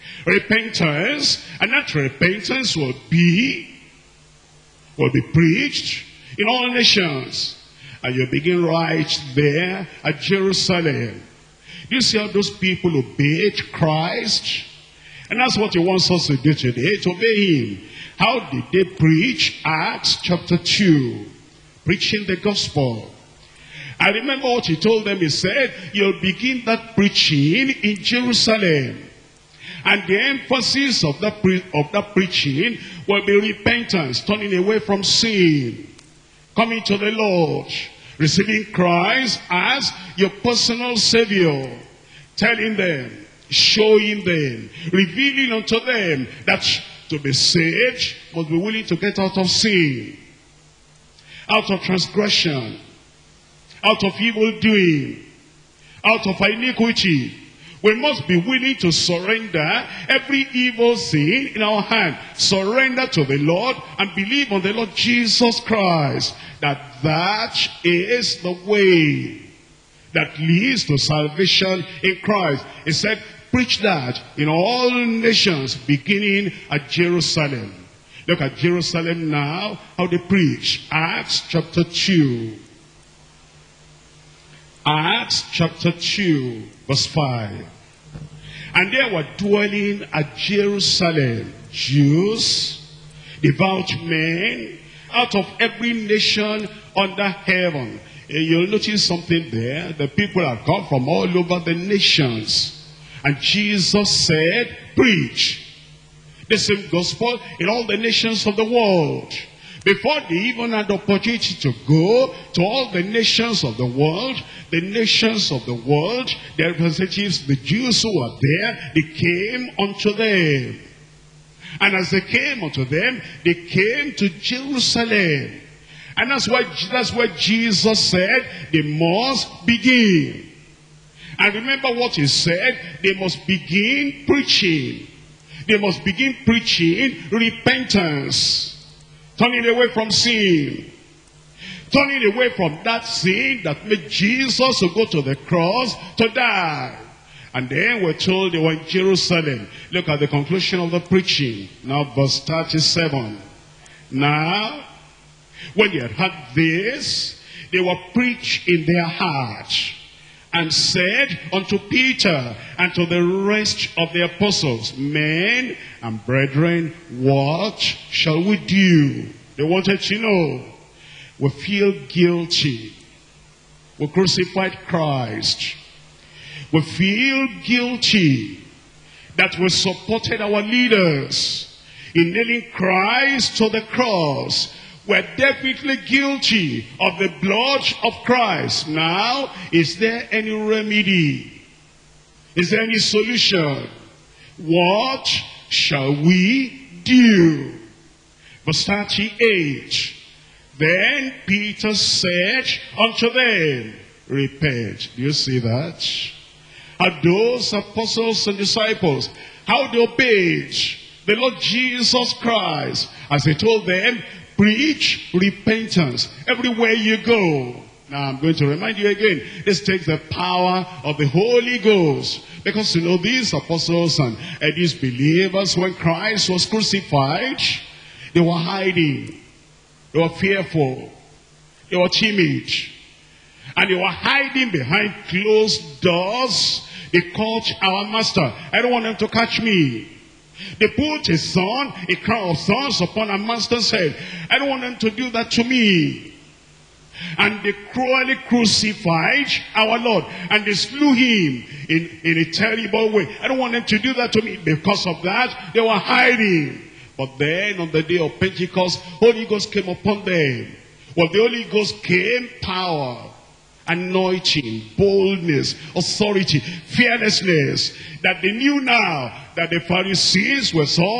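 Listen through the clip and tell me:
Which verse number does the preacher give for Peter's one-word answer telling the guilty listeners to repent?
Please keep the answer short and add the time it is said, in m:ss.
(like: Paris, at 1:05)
Verse 38, at 3:18.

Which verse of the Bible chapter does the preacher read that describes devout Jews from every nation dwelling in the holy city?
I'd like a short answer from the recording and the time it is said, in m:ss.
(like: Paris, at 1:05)
Verse 5, at 1:26.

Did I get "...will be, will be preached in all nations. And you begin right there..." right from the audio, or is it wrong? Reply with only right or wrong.
right.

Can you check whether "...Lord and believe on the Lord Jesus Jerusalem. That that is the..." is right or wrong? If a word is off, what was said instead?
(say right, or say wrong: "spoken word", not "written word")
wrong: "Christ", not "Jerusalem".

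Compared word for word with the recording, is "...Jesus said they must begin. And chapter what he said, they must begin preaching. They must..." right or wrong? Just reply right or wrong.
wrong.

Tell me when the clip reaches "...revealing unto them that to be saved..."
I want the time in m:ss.
0:44.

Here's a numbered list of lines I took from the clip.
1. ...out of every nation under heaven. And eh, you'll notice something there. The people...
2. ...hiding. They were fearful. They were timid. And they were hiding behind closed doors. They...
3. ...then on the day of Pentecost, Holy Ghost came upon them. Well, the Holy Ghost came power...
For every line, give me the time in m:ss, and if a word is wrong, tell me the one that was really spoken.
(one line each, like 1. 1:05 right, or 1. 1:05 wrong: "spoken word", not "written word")
1. 1:35 right
2. 3:48 right
3. 4:17 right.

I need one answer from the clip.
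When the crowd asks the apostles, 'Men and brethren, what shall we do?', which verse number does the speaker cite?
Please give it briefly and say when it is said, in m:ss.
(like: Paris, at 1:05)
Verse 37, at 2:32.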